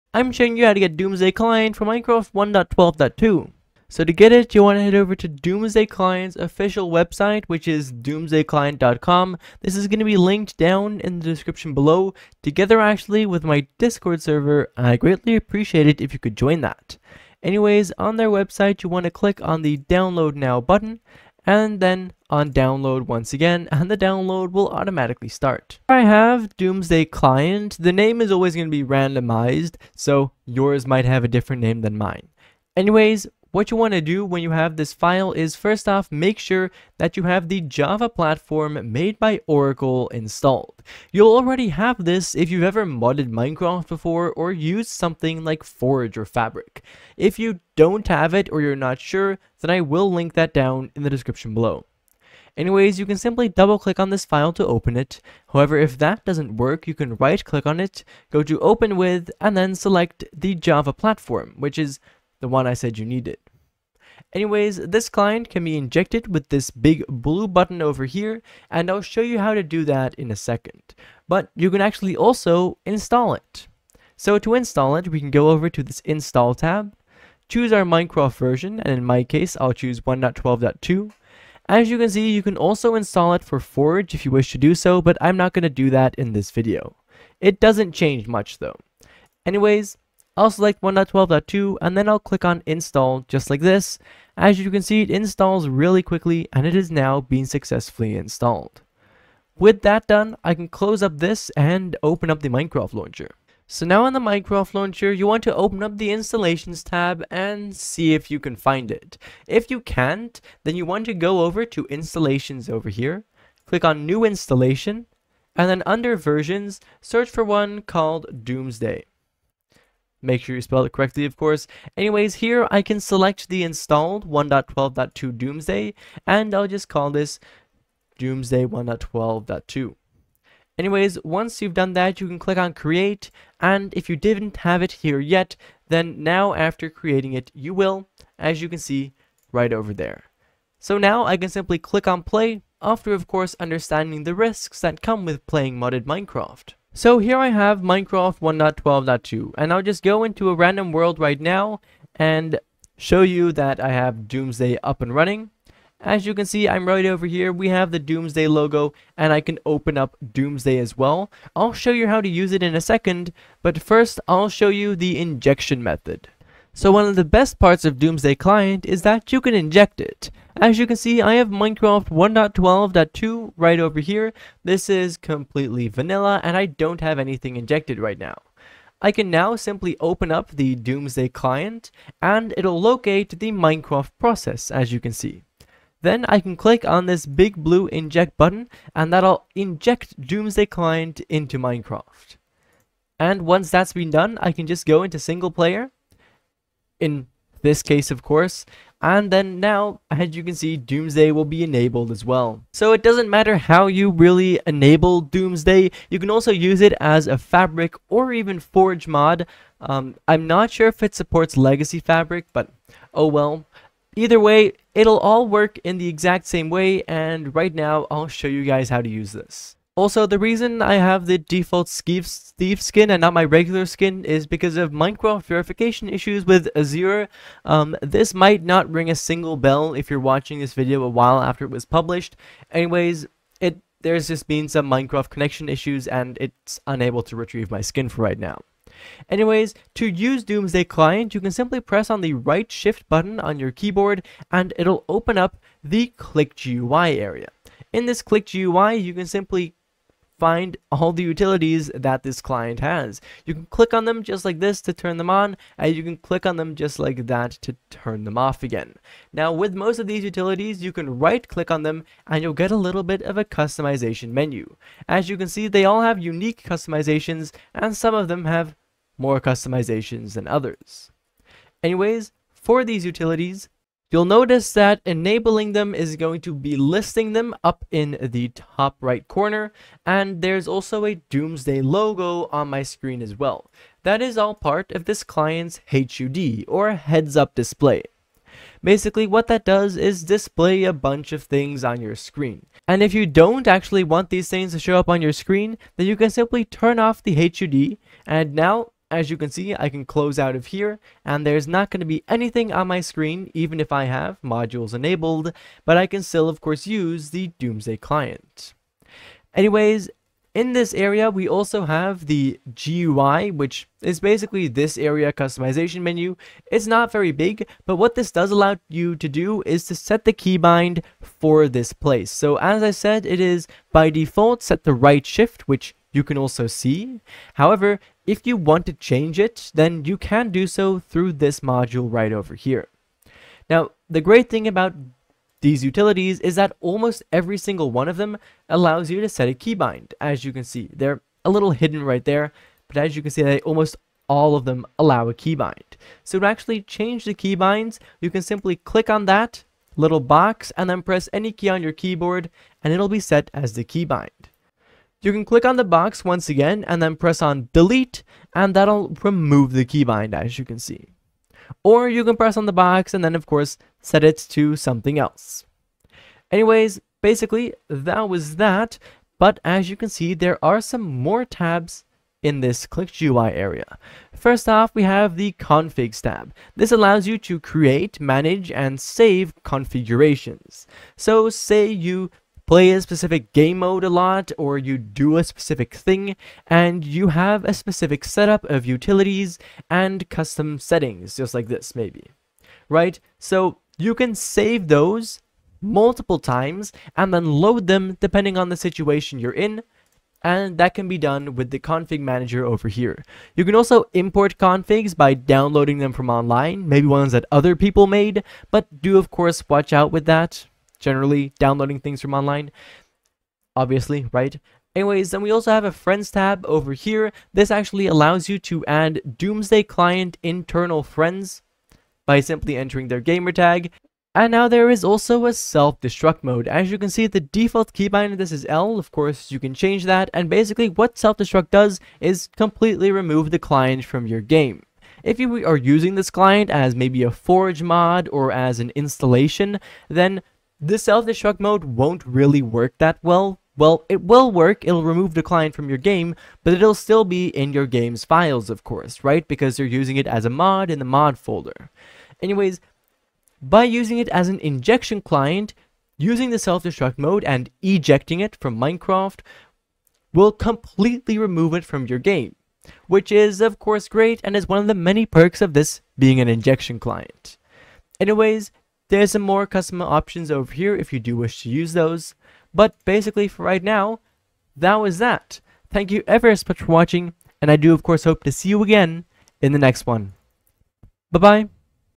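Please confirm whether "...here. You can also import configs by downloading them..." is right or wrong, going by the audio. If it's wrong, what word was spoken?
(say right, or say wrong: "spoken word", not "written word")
right.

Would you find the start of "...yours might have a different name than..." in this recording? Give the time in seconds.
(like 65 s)
30 s.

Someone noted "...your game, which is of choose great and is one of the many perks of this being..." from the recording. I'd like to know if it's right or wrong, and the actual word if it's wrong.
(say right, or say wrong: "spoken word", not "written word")
wrong: "course", not "choose".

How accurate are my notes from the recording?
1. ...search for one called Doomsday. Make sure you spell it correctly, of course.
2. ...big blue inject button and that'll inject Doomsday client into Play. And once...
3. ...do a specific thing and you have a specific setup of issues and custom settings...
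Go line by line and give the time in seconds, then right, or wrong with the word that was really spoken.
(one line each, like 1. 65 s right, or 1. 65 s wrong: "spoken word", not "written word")
1. 117 s right
2. 187 s wrong: "Minecraft", not "Play"
3. 384 s wrong: "utilities", not "issues".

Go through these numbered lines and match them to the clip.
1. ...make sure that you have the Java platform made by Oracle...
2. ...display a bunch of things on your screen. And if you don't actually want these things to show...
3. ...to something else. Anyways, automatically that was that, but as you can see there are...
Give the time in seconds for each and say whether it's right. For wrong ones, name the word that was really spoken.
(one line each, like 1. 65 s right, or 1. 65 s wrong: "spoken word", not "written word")
1. 36 s right
2. 290 s right
3. 364 s wrong: "basically", not "automatically".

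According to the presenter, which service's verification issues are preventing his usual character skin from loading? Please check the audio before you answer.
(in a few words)
Azure.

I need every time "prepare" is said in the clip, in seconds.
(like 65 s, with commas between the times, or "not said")
not said.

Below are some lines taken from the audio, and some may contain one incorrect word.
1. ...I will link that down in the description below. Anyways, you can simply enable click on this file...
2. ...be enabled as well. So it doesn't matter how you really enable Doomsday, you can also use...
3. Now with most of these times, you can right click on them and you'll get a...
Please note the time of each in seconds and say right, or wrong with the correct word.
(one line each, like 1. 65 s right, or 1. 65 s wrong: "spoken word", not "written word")
1. 49 s wrong: "double", not "enable"
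2. 201 s right
3. 259 s wrong: "utilities", not "times".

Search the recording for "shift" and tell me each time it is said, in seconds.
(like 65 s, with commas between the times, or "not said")
242 s, 325 s.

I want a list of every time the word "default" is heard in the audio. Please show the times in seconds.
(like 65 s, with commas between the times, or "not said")
221 s, 324 s, 427 s.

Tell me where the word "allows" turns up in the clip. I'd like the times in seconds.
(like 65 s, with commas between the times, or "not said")
318 s, 338 s, 344 s, 376 s, 418 s.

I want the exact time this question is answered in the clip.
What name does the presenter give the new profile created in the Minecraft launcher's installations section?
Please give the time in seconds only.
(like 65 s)
128 s.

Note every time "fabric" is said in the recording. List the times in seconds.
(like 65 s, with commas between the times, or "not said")
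46 s, 207 s, 211 s.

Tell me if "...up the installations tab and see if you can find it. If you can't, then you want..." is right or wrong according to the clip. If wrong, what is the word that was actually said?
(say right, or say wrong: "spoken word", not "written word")
right.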